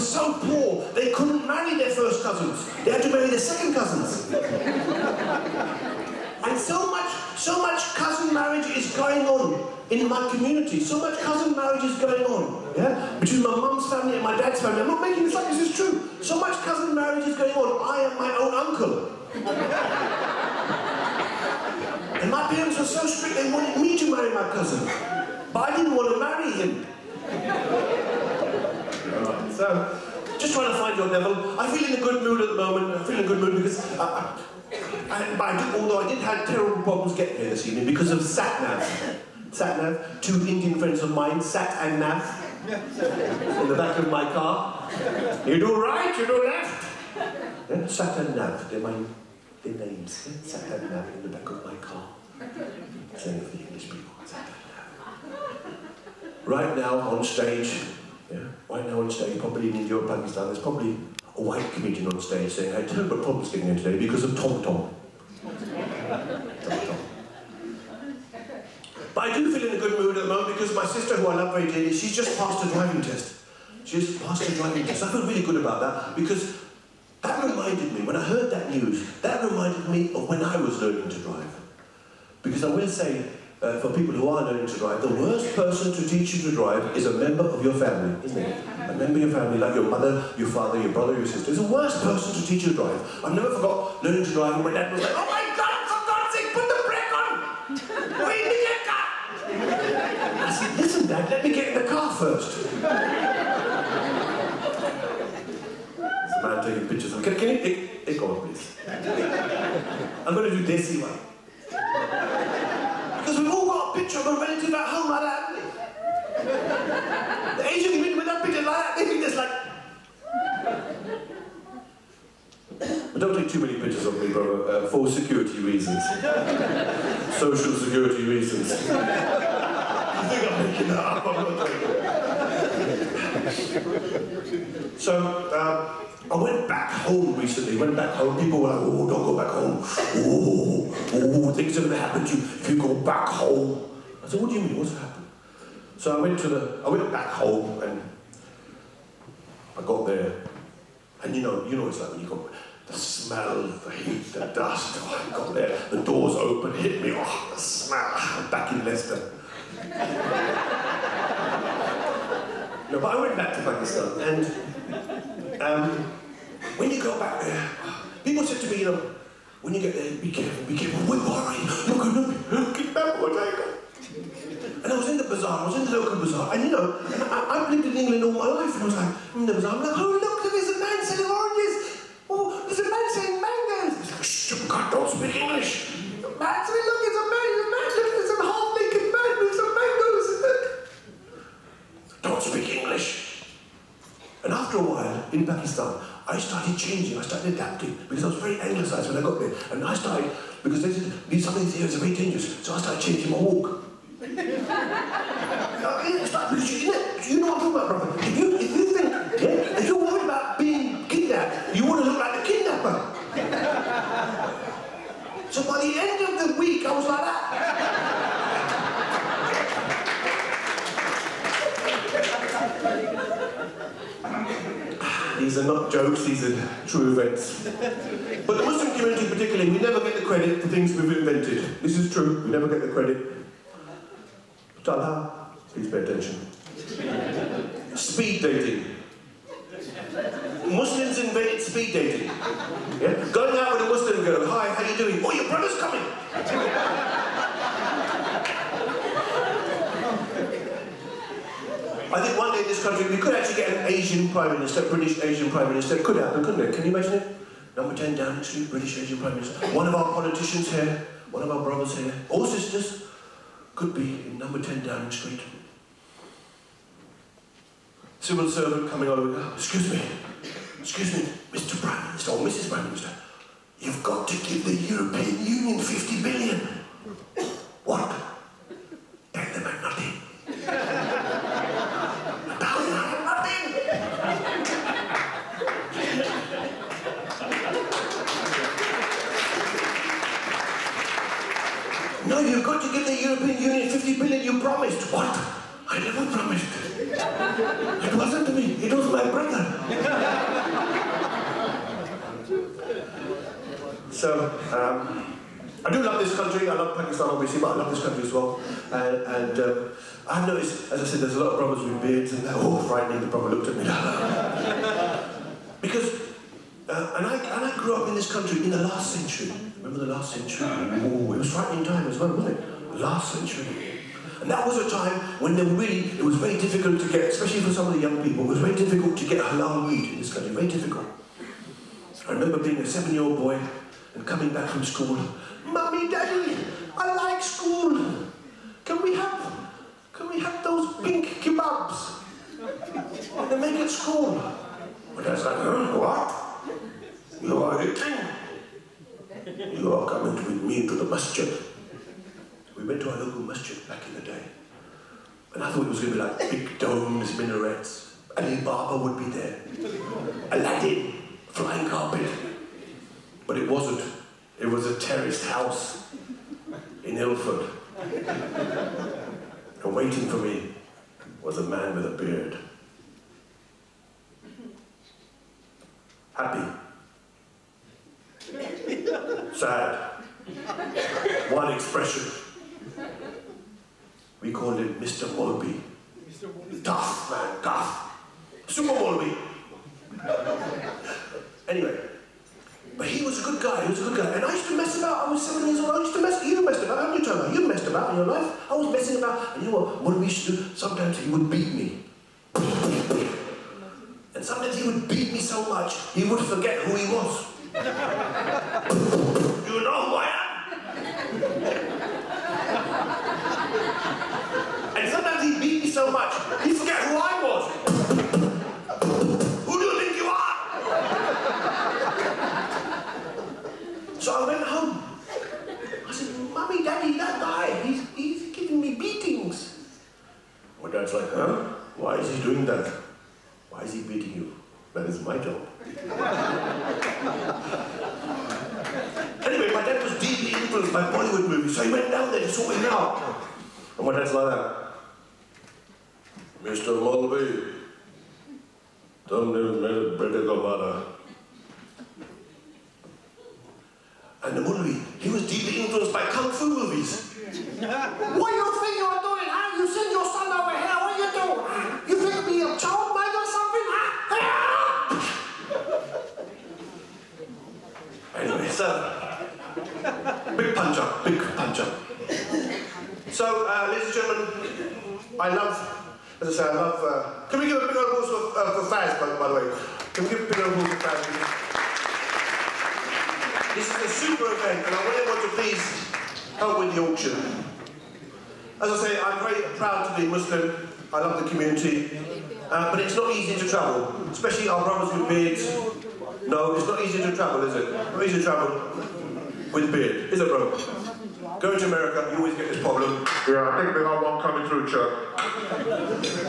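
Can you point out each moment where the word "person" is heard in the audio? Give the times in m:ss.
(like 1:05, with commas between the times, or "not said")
1:25, 1:32.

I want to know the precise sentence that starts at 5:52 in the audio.
We went to our local masjid back in the day.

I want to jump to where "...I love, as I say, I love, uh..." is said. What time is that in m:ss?
7:55.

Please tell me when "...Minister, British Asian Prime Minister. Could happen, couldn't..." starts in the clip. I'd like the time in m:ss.
4:14.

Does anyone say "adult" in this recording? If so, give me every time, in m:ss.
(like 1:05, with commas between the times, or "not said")
not said.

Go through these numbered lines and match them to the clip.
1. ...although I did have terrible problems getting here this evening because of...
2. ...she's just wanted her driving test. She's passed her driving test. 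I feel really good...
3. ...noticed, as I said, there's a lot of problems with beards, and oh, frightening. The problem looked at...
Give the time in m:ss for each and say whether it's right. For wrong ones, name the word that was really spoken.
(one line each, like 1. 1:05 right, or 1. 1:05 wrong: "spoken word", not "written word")
1. 0:35 right
2. 1:11 wrong: "passed", not "wanted"
3. 5:10 right.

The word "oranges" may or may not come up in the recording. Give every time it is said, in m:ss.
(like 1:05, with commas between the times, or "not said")
3:01.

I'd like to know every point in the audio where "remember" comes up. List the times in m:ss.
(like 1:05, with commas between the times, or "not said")
2:52, 5:19, 5:32.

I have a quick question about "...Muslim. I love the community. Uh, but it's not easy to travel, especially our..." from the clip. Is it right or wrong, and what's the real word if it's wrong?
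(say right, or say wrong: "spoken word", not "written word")
right.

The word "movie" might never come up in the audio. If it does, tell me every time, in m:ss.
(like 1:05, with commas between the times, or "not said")
7:21, 7:36.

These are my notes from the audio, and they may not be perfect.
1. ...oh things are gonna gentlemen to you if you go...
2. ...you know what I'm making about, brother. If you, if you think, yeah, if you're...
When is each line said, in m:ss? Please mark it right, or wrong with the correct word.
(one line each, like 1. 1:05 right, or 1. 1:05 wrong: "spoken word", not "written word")
1. 2:21 wrong: "happen", not "gentlemen"
2. 3:27 wrong: "talking", not "making".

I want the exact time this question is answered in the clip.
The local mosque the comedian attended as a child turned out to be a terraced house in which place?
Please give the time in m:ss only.
6:07.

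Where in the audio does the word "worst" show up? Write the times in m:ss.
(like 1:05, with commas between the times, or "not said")
1:25, 1:31.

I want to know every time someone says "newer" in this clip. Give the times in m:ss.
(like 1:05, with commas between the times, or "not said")
not said.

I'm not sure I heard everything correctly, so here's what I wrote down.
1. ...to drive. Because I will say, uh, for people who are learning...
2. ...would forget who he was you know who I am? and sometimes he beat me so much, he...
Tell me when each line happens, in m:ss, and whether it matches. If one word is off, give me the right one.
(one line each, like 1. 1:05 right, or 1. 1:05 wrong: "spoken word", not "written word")
1. 1:21 right
2. 6:46 right.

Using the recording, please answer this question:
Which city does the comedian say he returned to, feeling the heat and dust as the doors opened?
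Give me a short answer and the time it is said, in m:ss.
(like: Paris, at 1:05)
Leicester, at 2:38.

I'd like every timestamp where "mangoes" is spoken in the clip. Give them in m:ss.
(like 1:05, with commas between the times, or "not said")
3:03, 3:09.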